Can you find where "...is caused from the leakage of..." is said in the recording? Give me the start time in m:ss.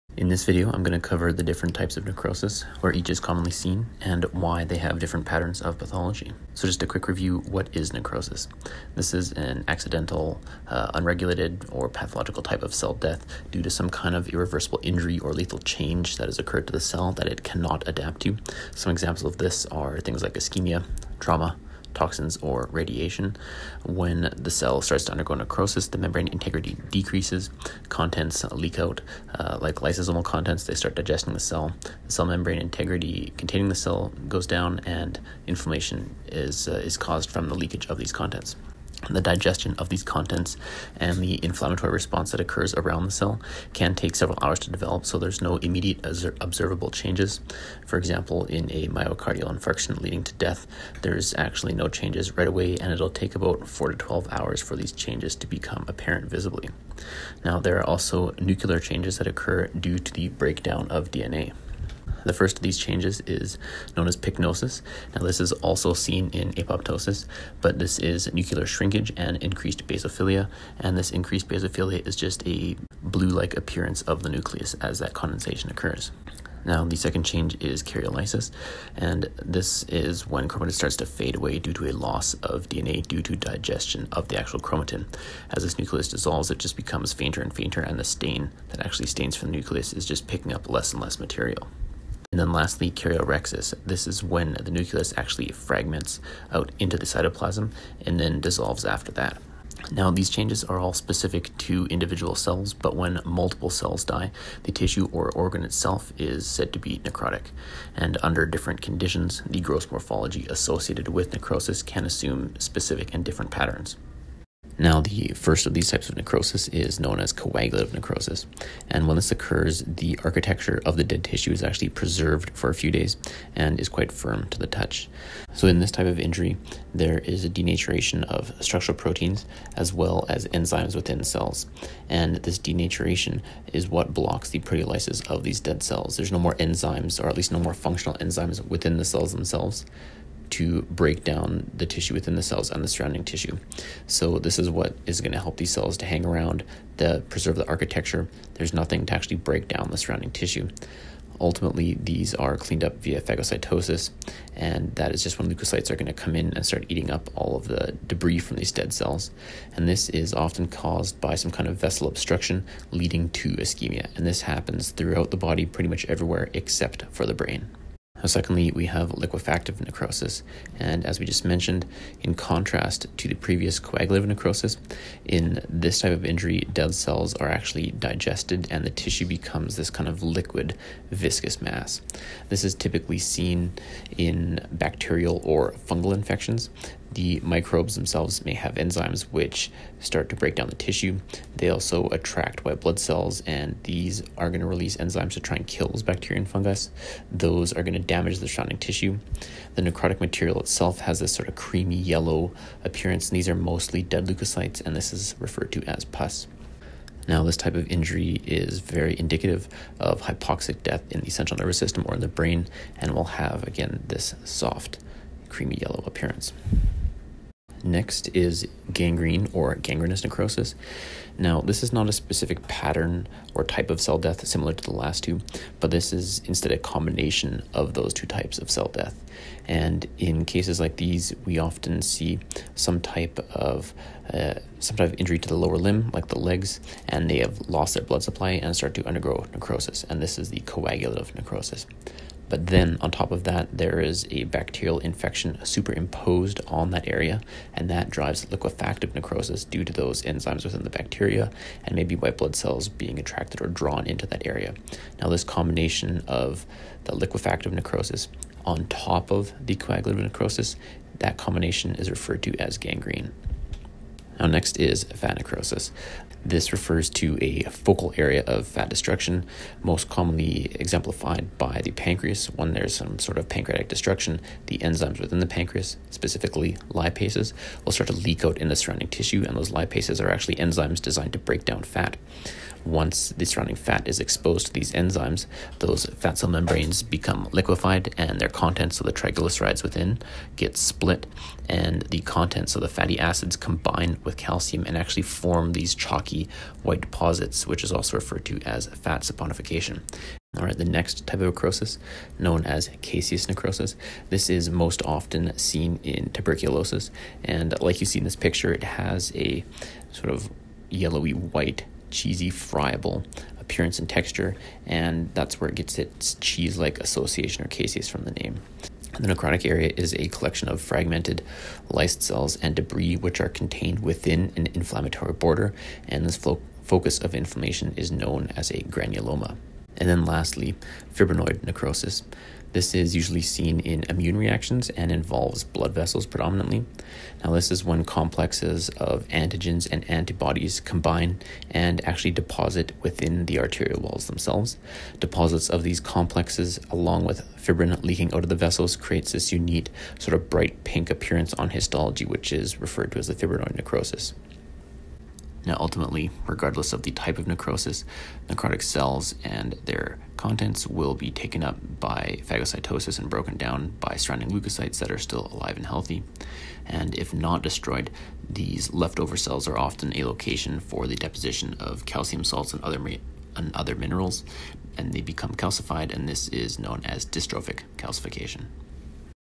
0:36.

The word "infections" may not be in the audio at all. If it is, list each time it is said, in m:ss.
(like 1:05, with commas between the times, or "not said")
3:06, 4:04.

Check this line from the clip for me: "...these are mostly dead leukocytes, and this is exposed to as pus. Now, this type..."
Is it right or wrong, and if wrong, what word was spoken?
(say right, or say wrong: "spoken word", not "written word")
wrong: "referred", not "exposed".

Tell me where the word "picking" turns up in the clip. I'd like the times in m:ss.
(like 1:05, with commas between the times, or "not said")
1:30.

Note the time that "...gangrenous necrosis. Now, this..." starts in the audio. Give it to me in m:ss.
3:39.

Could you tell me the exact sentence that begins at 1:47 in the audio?
And under different conditions, the gross morphology associated with necrosis can assume specific and different patterns.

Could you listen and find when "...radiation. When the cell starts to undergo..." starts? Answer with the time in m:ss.
0:22.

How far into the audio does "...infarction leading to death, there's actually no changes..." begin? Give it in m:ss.
0:49.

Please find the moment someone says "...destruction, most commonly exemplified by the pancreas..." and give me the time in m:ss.
4:28.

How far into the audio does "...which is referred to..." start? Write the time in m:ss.
5:52.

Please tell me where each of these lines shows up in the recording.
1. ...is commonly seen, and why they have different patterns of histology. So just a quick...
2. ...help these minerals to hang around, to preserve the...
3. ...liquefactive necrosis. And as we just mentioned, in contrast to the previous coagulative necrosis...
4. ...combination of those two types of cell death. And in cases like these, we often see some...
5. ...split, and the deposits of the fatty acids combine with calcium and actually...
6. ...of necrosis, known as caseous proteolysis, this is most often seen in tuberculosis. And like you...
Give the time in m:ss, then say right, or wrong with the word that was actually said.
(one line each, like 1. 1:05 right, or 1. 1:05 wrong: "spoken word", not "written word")
1. 0:03 wrong: "pathology", not "histology"
2. 2:25 wrong: "cells", not "minerals"
3. 2:49 right
4. 3:46 right
5. 4:50 wrong: "contents", not "deposits"
6. 5:01 wrong: "necrosis", not "proteolysis".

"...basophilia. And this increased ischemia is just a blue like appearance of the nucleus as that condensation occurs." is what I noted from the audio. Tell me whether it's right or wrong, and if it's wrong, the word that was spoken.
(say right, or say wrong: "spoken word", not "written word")
wrong: "basophilia", not "ischemia".